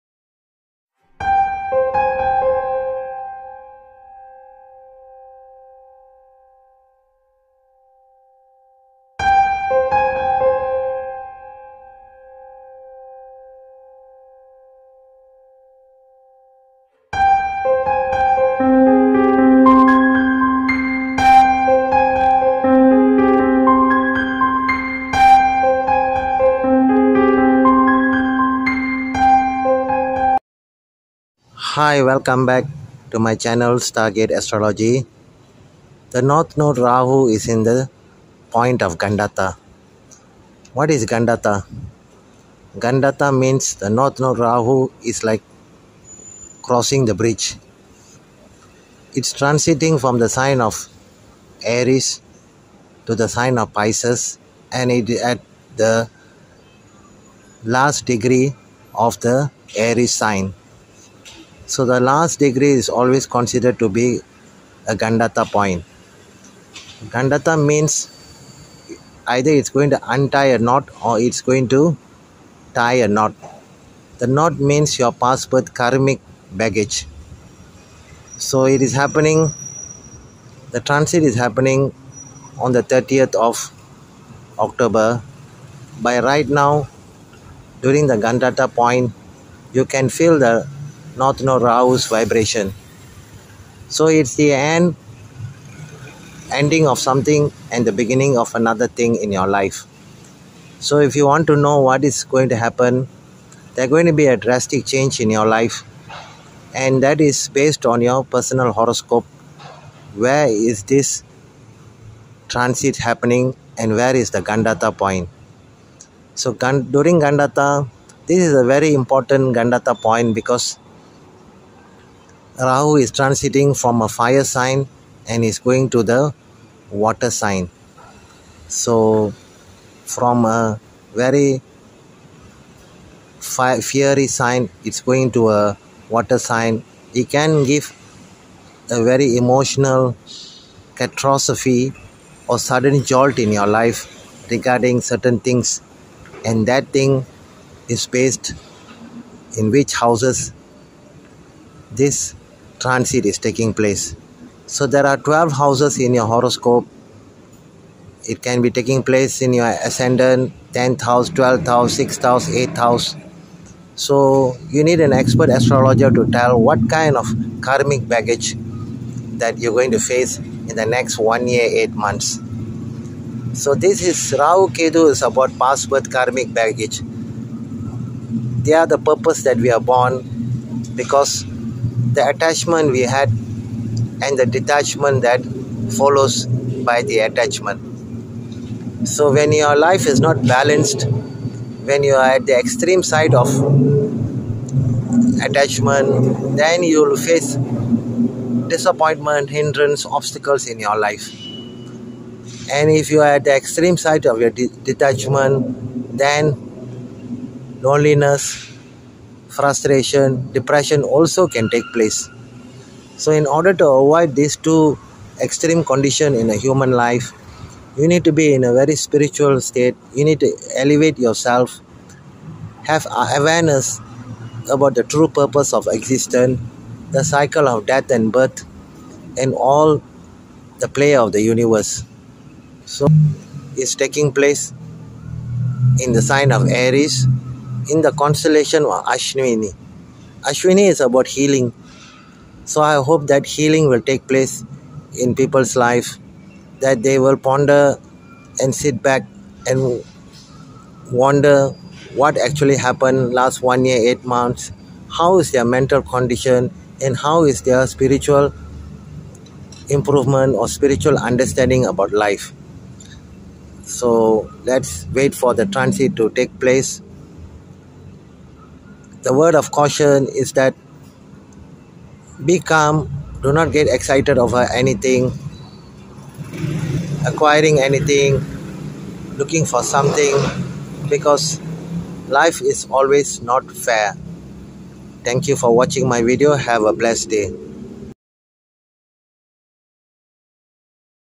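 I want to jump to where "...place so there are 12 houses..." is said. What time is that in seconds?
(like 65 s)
153 s.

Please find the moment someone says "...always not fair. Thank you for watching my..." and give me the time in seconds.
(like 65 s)
282 s.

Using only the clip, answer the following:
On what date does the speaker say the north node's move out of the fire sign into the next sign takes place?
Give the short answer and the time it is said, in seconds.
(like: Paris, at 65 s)
30 October, at 82 s.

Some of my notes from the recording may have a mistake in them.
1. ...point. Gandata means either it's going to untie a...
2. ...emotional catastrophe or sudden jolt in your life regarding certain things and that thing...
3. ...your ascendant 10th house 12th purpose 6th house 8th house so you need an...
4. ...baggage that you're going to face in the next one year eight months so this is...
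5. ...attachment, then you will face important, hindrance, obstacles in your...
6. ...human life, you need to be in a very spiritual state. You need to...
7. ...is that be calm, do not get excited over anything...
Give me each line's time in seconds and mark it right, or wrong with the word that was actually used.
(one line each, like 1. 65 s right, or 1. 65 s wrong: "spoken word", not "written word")
1. 65 s right
2. 139 s right
3. 159 s wrong: "house", not "purpose"
4. 168 s right
5. 195 s wrong: "disappointment", not "important"
6. 216 s right
7. 270 s right.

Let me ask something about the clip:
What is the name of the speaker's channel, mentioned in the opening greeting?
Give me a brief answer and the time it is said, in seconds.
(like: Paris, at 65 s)
Stargate Astrology, at 33 s.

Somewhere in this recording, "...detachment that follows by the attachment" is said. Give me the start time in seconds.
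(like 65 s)
184 s.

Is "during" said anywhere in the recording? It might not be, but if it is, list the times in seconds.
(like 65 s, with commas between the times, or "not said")
87 s, 116 s.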